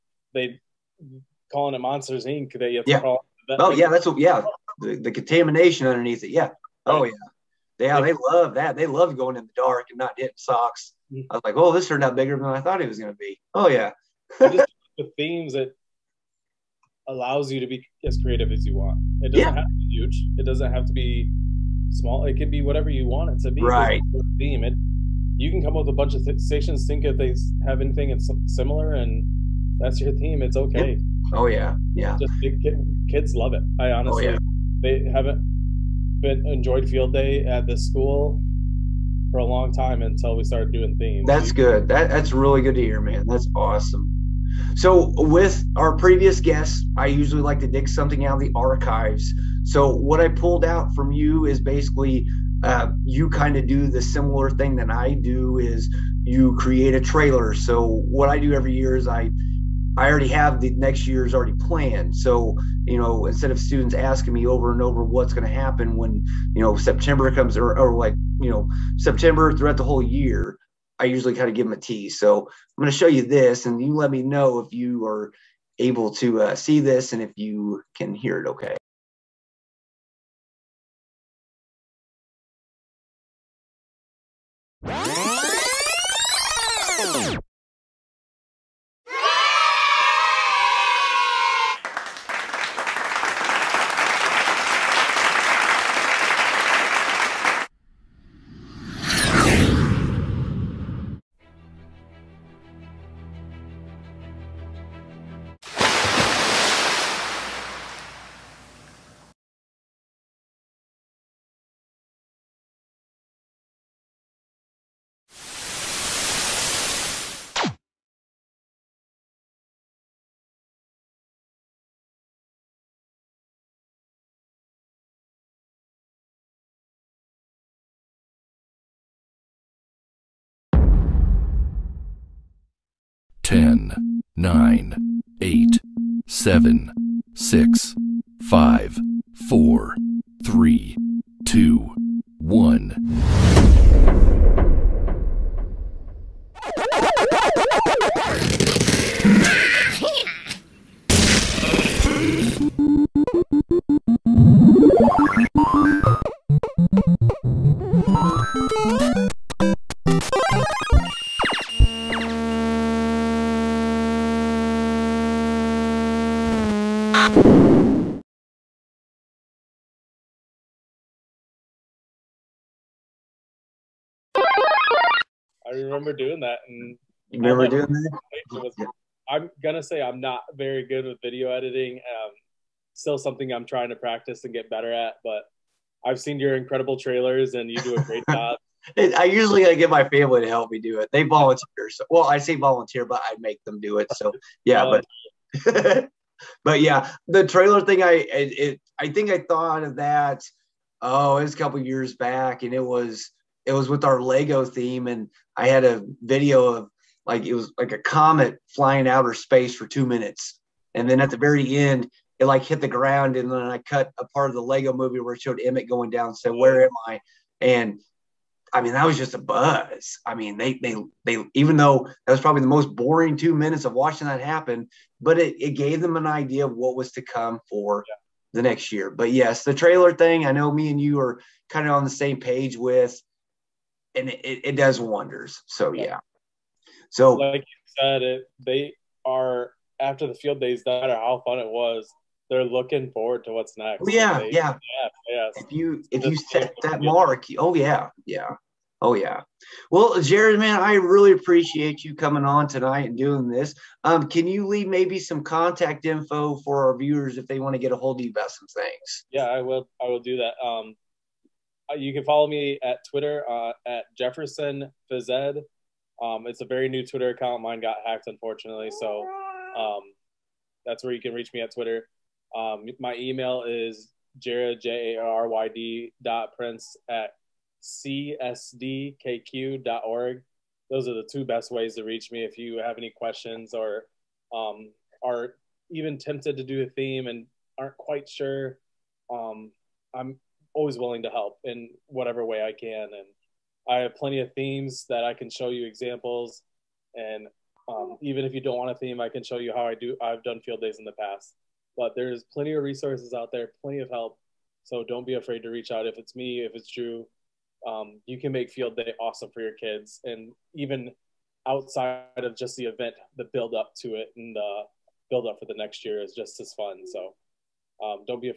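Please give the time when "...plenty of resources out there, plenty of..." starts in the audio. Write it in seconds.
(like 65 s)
302 s.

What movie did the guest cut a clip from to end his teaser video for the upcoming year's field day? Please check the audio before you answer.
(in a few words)
The Lego Movie.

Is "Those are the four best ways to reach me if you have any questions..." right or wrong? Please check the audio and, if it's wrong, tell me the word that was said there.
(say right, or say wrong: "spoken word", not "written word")
wrong: "two", not "four".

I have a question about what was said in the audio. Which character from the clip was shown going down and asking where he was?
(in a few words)
Emmet.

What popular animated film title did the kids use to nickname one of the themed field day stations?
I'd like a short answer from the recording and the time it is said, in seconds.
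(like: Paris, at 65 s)
Monsters Inc., at 1 s.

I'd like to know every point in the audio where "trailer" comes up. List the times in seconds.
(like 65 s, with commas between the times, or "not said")
56 s, 186 s, 197 s, 229 s.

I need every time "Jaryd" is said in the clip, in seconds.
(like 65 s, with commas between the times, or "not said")
250 s, 274 s.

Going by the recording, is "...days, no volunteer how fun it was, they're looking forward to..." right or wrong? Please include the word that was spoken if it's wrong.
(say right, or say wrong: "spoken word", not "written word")
wrong: "matter", not "volunteer".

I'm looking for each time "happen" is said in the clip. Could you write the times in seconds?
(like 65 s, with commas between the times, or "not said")
65 s, 224 s.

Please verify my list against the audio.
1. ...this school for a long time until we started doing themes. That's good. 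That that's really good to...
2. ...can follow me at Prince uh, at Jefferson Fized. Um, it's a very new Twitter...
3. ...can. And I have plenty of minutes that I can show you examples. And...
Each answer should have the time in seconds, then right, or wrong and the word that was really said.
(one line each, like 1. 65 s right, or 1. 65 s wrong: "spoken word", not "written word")
1. 37 s right
2. 262 s wrong: "Twitter", not "Prince"
3. 292 s wrong: "themes", not "minutes".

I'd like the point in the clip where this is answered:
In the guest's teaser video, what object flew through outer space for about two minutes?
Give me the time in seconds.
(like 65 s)
207 s.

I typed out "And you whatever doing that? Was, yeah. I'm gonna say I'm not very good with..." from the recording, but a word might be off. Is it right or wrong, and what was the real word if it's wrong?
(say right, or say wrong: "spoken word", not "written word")
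wrong: "remember", not "whatever".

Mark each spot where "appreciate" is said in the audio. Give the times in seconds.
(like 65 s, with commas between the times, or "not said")
251 s.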